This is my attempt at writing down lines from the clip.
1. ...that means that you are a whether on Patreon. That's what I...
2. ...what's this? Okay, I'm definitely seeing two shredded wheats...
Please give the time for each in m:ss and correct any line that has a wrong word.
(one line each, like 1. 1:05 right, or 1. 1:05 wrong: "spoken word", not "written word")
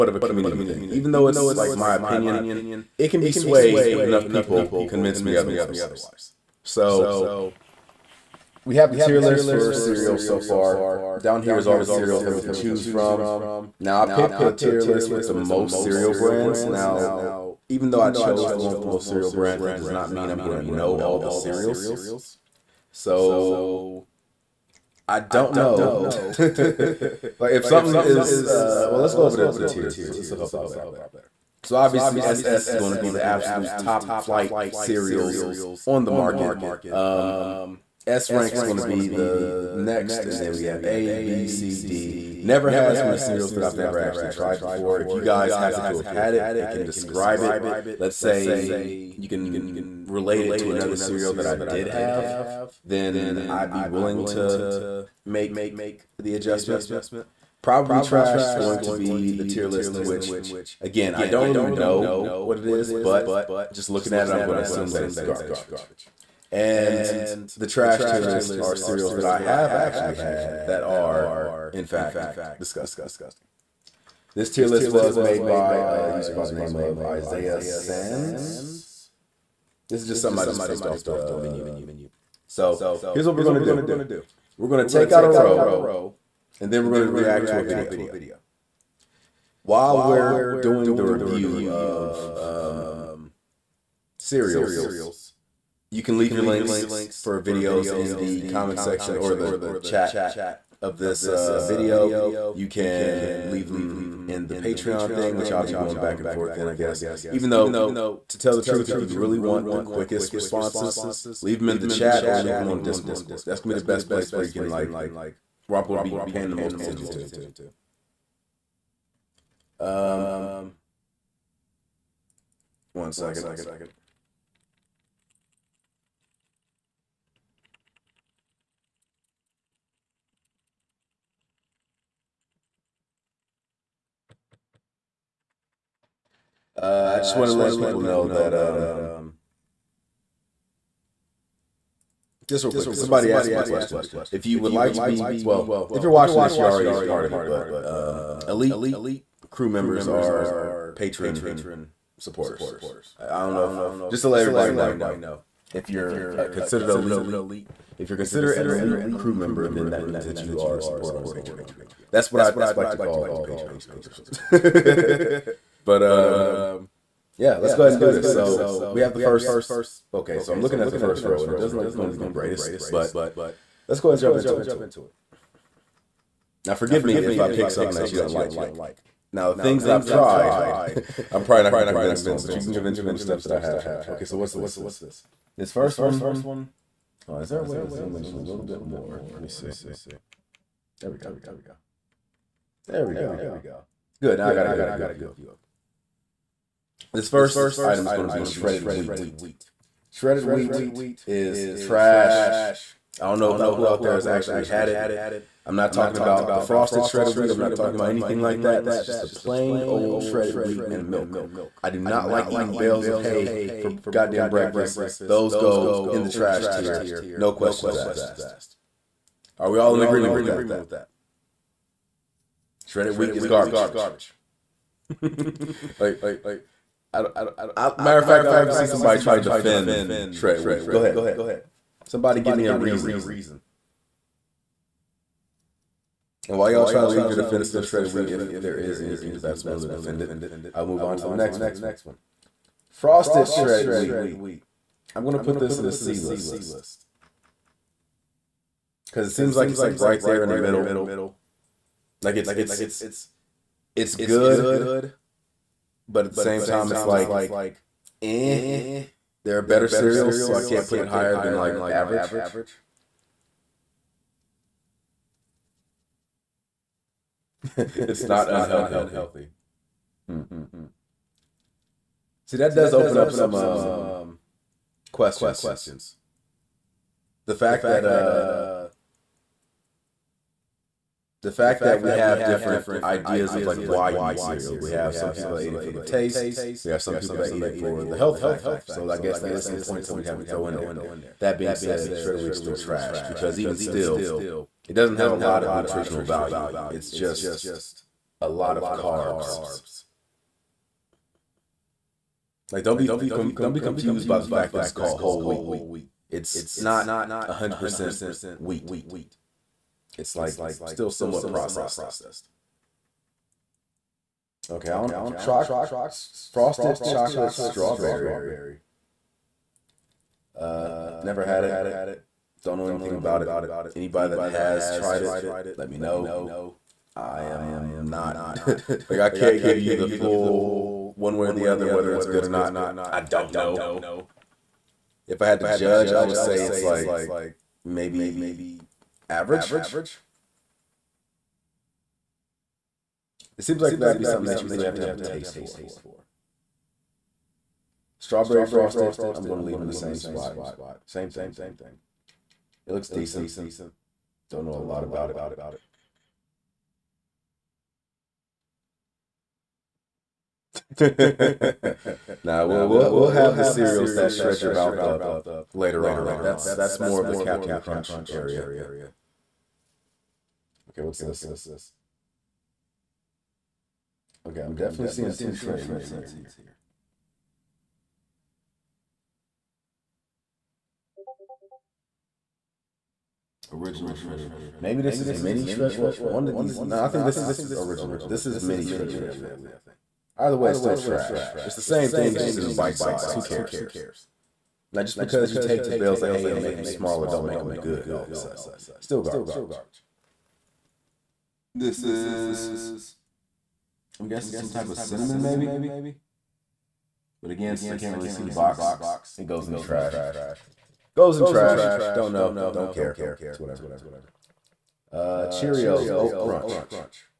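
1. 2:39 wrong: "supporter", not "whether"
2. 6:11 right.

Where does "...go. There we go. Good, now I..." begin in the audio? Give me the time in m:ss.
3:11.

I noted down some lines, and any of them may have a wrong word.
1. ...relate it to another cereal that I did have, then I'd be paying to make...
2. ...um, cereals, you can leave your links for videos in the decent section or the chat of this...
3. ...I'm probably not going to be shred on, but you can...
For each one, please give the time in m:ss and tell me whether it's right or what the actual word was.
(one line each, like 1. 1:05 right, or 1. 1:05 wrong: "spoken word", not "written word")
1. 0:50 wrong: "willing", not "paying"
2. 1:32 wrong: "comment", not "decent"
3. 3:01 wrong: "convinced", not "shred".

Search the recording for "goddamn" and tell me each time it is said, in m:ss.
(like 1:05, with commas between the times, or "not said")
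3:34.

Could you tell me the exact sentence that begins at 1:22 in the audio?
So here's what we're going to do.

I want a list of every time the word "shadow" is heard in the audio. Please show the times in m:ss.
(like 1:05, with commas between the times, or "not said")
not said.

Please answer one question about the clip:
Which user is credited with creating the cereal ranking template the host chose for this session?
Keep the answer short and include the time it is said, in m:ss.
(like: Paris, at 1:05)
Isaiah Sands, at 1:17.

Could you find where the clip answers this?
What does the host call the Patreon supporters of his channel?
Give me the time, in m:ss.
2:28.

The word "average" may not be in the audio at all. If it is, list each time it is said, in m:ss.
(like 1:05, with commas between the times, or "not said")
4:21, 5:39.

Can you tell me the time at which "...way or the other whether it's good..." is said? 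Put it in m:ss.
5:31.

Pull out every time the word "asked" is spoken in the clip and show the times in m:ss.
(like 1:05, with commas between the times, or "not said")
2:23, 3:37.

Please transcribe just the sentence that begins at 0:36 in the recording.
Um, S rank is going to be the next, and then we have A, B, C, D.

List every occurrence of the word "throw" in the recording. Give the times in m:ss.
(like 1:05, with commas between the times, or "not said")
4:50.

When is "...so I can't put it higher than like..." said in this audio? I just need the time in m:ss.
4:20.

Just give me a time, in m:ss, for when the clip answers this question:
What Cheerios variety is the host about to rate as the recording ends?
6:55.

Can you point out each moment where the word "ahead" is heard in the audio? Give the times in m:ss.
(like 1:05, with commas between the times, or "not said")
2:47, 2:54, 3:51.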